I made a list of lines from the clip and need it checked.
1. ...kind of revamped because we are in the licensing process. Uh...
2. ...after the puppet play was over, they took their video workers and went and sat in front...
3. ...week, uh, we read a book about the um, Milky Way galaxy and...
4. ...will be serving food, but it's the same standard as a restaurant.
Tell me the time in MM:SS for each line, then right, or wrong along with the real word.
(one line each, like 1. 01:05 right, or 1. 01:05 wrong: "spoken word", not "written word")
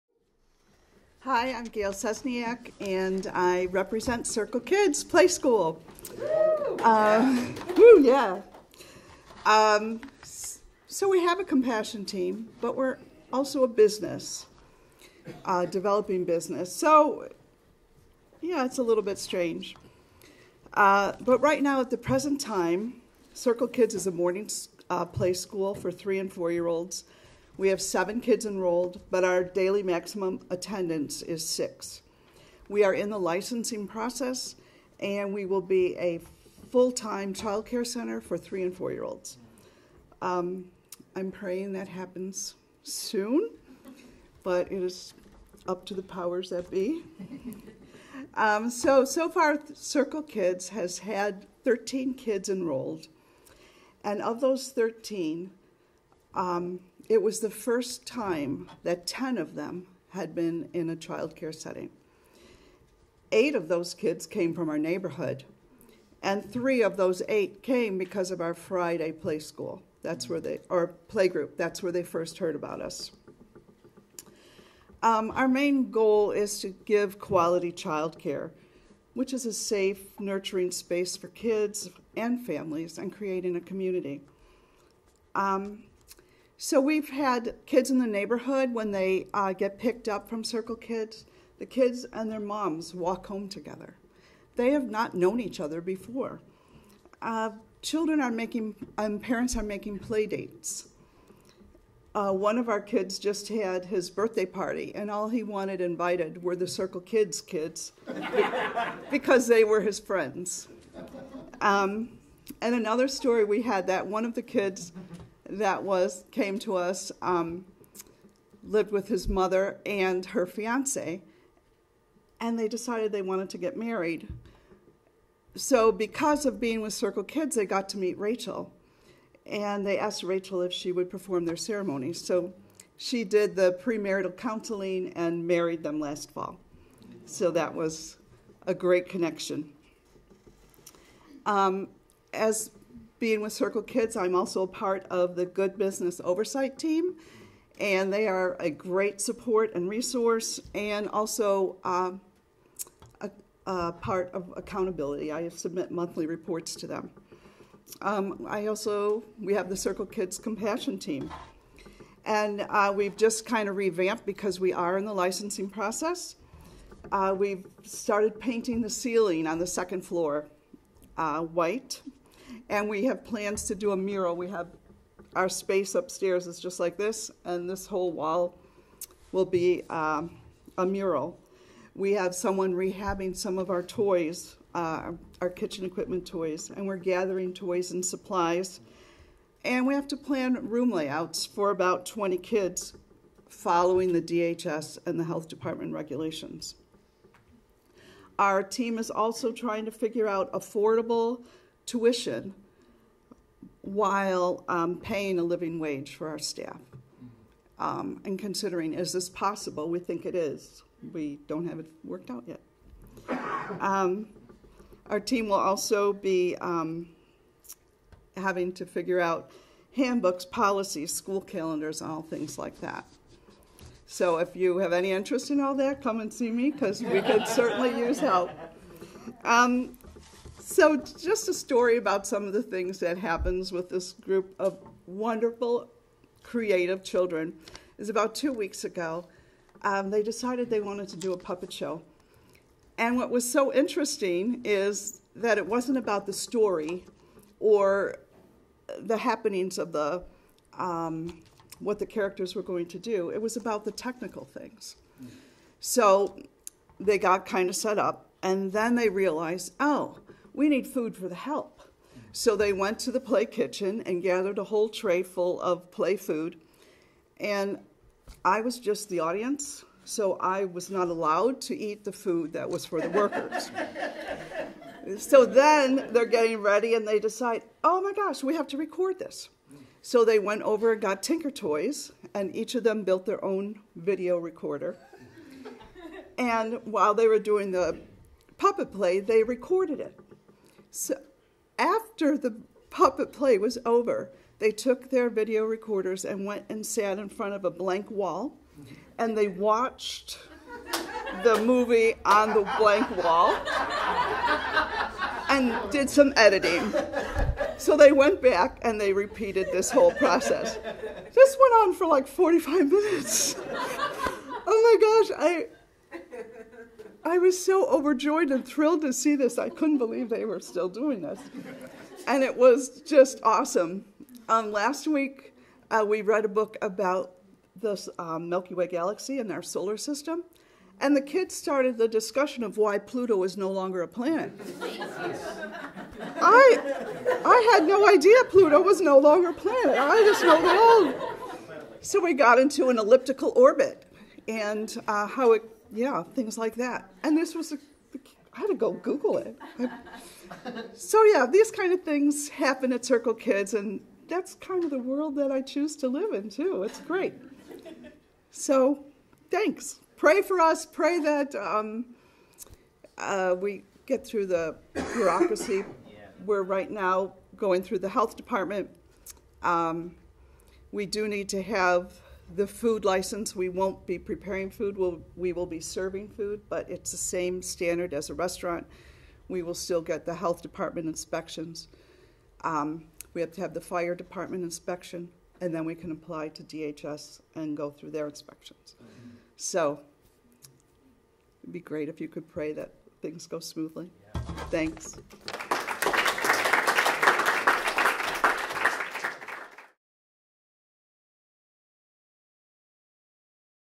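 1. 02:43 right
2. 04:51 wrong: "recorders", not "workers"
3. 05:25 right
4. 06:15 right.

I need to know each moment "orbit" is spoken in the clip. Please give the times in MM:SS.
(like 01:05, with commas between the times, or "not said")
05:43.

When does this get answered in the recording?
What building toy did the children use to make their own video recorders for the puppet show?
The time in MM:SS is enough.
04:41.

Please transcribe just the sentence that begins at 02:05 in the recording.
So, because of being with Circle Kids, they got to meet Rachel, and they asked Rachel if she would perform their ceremony.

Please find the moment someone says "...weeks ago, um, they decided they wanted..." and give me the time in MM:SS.
03:58.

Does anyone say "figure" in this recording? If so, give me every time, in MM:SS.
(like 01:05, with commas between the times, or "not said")
03:19, 03:38.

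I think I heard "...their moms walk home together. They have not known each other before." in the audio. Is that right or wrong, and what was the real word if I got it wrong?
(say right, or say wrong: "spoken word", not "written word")
right.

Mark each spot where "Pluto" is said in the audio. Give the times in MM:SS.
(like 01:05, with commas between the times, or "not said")
05:32, 05:38.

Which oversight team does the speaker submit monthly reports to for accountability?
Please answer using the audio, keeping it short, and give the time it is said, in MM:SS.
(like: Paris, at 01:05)
Good Business Oversight Team, at 02:25.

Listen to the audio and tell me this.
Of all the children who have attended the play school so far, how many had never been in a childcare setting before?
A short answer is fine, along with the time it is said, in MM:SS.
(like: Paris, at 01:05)
10, at 00:59.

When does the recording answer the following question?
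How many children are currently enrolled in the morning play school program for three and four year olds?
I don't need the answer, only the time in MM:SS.
00:27.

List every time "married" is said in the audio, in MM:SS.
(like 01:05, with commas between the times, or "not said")
02:03, 02:15.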